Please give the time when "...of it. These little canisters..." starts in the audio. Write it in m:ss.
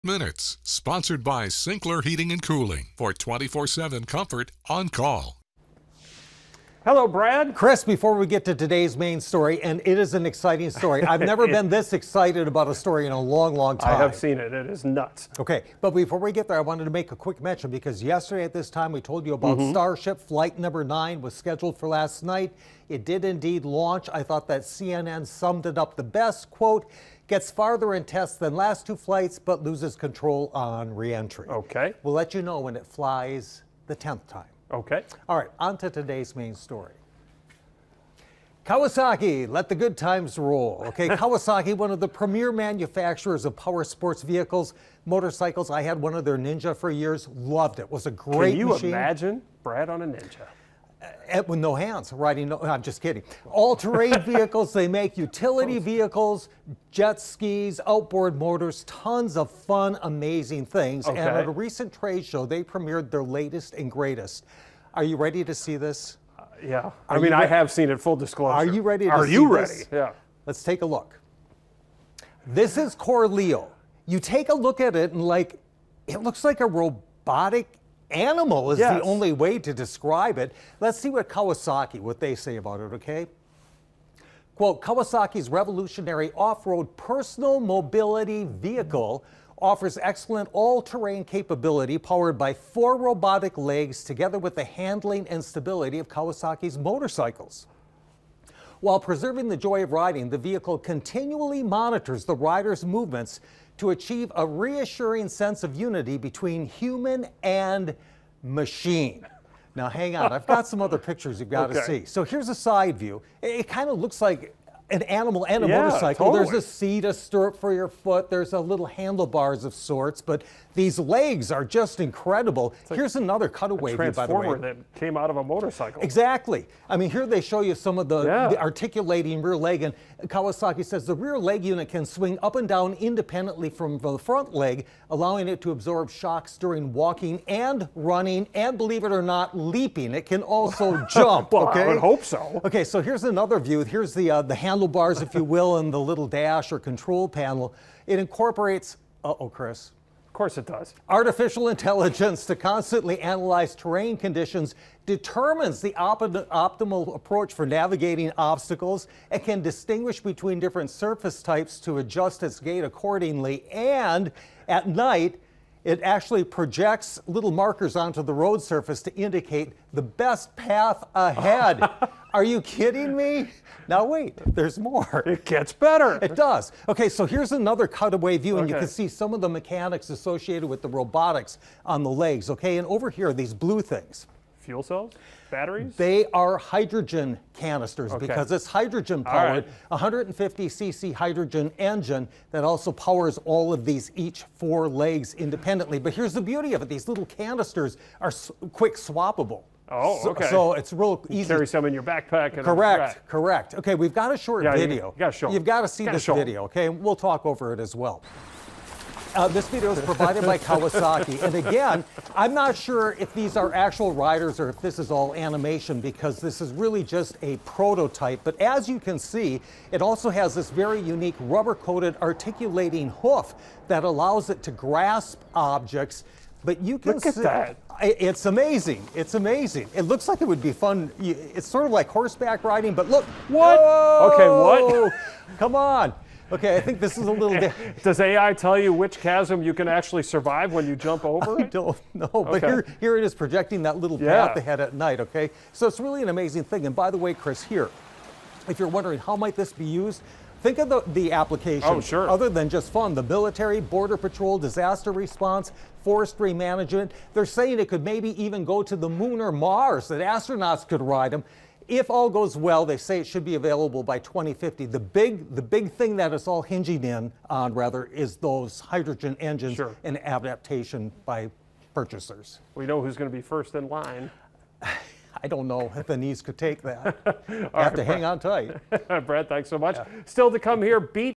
3:16.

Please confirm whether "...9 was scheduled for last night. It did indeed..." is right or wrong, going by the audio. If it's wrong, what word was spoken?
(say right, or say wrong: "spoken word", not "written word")
right.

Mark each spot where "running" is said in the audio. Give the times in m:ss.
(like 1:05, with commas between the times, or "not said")
2:17.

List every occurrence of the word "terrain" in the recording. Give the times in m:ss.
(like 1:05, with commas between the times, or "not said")
0:53, 1:30, 2:33.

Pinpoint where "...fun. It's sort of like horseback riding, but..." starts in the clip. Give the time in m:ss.
3:50.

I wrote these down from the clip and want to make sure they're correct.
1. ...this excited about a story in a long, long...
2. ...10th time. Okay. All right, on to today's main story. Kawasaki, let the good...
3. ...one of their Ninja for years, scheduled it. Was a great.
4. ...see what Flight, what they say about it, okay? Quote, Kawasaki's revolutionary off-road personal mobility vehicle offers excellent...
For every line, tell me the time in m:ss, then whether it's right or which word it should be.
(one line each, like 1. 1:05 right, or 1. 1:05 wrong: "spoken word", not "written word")
1. 0:11 right
2. 0:33 right
3. 0:45 wrong: "loved", not "scheduled"
4. 1:20 wrong: "Kawasaki", not "Flight".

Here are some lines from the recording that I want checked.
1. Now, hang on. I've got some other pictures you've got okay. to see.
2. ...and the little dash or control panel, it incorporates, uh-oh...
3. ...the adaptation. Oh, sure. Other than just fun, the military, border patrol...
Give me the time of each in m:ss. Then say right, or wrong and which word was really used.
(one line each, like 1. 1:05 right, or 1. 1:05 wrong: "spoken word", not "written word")
1. 1:49 right
2. 2:25 right
3. 4:11 wrong: "application", not "adaptation".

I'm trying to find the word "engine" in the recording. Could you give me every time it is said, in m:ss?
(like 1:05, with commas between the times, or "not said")
3:11, 4:29.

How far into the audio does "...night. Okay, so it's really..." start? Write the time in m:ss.
4:04.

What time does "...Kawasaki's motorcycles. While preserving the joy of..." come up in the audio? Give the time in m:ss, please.
1:36.